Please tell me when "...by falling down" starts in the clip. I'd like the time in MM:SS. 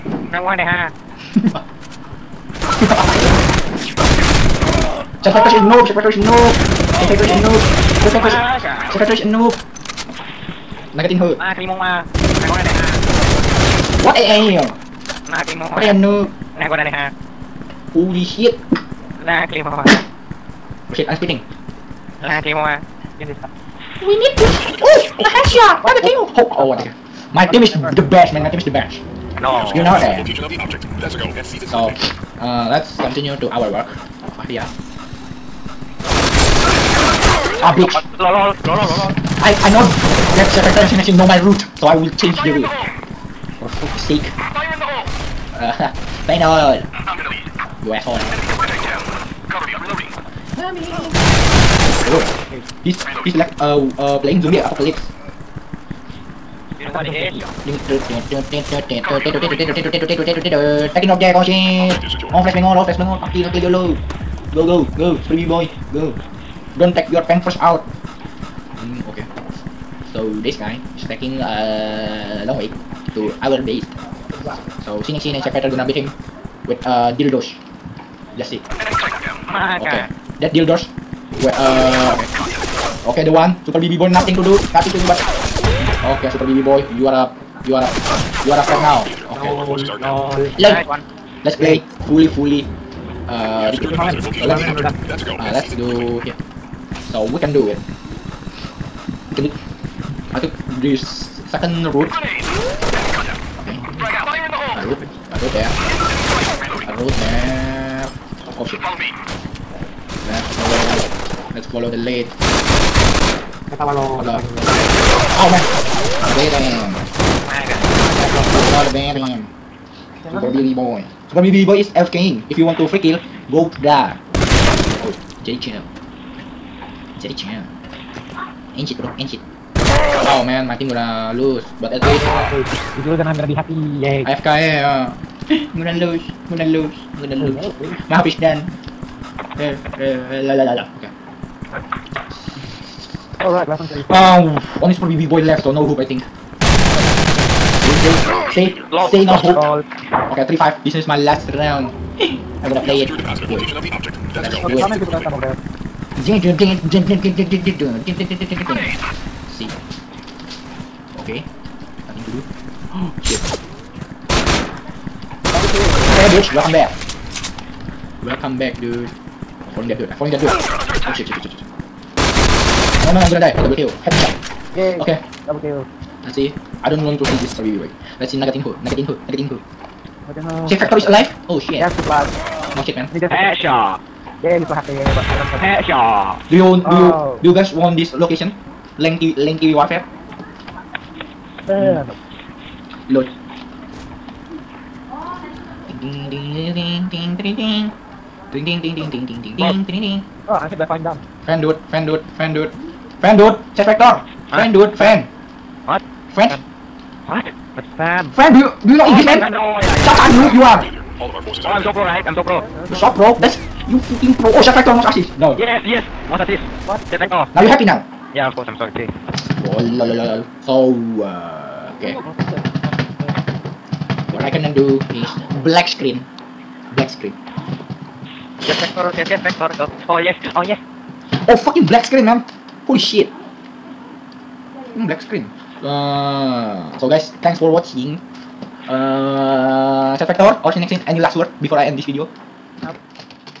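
03:20.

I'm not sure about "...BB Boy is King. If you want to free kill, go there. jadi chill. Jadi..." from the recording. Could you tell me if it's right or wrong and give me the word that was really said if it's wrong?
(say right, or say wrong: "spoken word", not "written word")
right.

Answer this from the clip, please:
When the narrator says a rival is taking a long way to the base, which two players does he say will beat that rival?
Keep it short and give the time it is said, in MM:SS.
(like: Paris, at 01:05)
Sinixin and Sekret, at 01:15.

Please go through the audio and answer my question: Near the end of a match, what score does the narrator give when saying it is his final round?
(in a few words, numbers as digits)
3-5.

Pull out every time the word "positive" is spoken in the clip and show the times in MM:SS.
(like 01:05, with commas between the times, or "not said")
01:33, 02:33.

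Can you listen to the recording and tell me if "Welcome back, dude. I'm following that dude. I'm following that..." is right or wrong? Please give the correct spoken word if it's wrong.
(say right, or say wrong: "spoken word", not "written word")
right.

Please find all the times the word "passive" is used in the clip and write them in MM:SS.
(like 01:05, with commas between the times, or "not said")
not said.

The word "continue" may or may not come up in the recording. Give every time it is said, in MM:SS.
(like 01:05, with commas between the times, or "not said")
00:32.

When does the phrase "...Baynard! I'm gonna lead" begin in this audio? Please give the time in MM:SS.
00:46.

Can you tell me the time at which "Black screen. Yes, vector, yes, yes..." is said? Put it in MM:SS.
03:46.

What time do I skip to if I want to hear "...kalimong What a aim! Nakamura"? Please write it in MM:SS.
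00:11.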